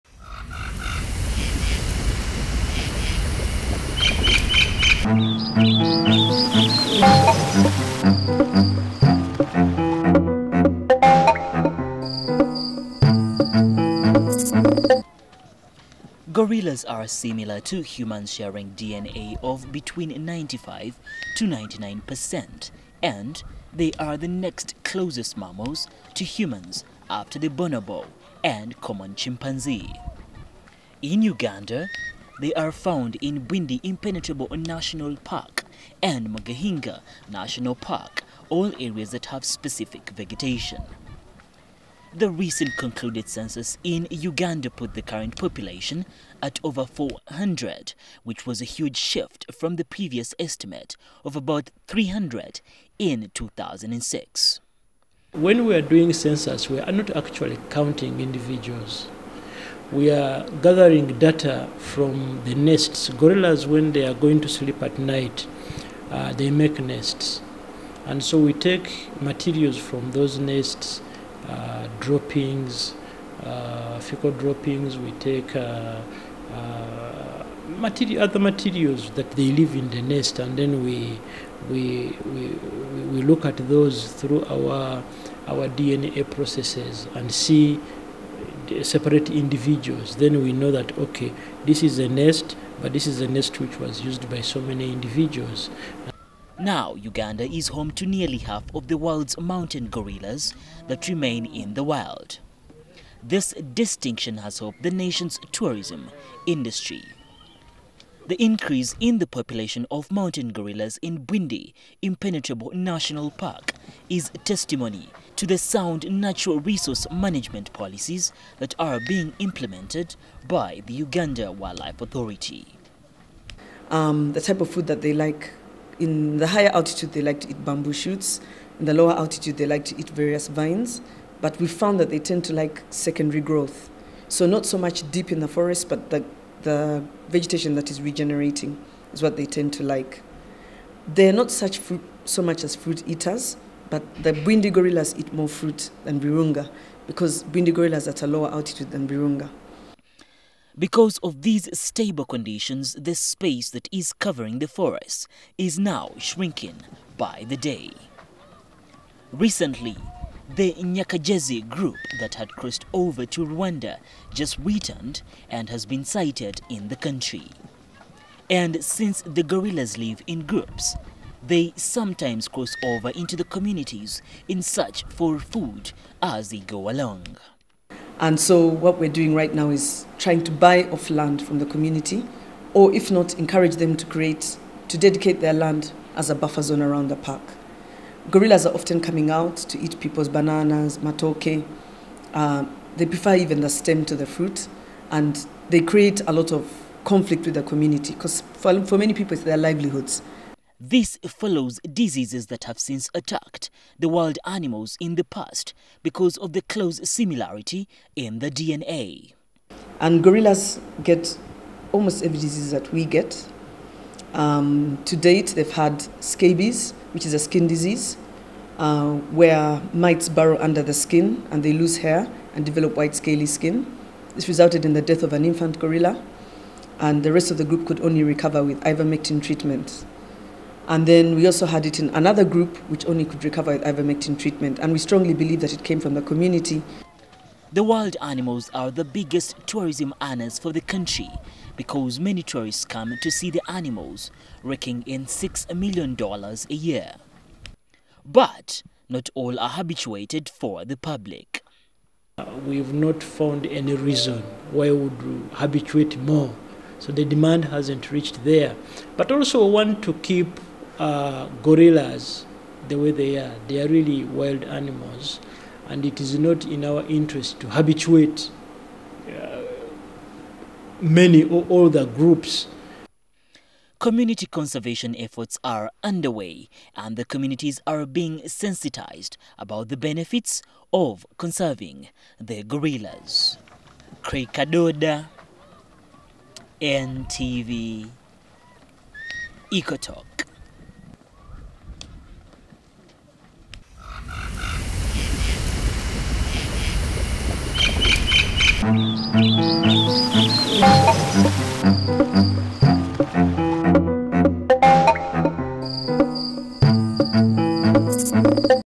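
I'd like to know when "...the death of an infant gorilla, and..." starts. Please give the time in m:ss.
3:44.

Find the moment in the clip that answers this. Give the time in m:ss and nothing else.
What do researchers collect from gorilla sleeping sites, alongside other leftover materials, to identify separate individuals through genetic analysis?
1:13.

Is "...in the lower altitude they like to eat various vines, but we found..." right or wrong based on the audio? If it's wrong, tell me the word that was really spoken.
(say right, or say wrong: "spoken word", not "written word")
right.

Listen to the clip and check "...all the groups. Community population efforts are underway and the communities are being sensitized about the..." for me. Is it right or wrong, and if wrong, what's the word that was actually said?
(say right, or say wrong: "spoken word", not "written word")
wrong: "conservation", not "population".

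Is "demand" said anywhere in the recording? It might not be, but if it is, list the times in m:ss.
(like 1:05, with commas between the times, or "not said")
4:17.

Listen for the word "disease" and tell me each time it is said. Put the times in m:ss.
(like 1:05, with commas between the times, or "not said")
3:21, 3:32, 3:37.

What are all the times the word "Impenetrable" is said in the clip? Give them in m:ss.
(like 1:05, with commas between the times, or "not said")
0:33, 1:52.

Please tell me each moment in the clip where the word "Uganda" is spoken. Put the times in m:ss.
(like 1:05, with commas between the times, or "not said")
0:31, 0:44, 1:36, 2:00.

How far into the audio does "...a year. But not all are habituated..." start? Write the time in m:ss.
4:06.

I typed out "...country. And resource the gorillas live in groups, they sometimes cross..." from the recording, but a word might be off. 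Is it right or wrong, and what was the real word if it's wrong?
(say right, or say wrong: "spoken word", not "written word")
wrong: "since", not "resource".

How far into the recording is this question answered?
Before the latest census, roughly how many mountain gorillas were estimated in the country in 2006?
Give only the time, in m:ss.
0:51.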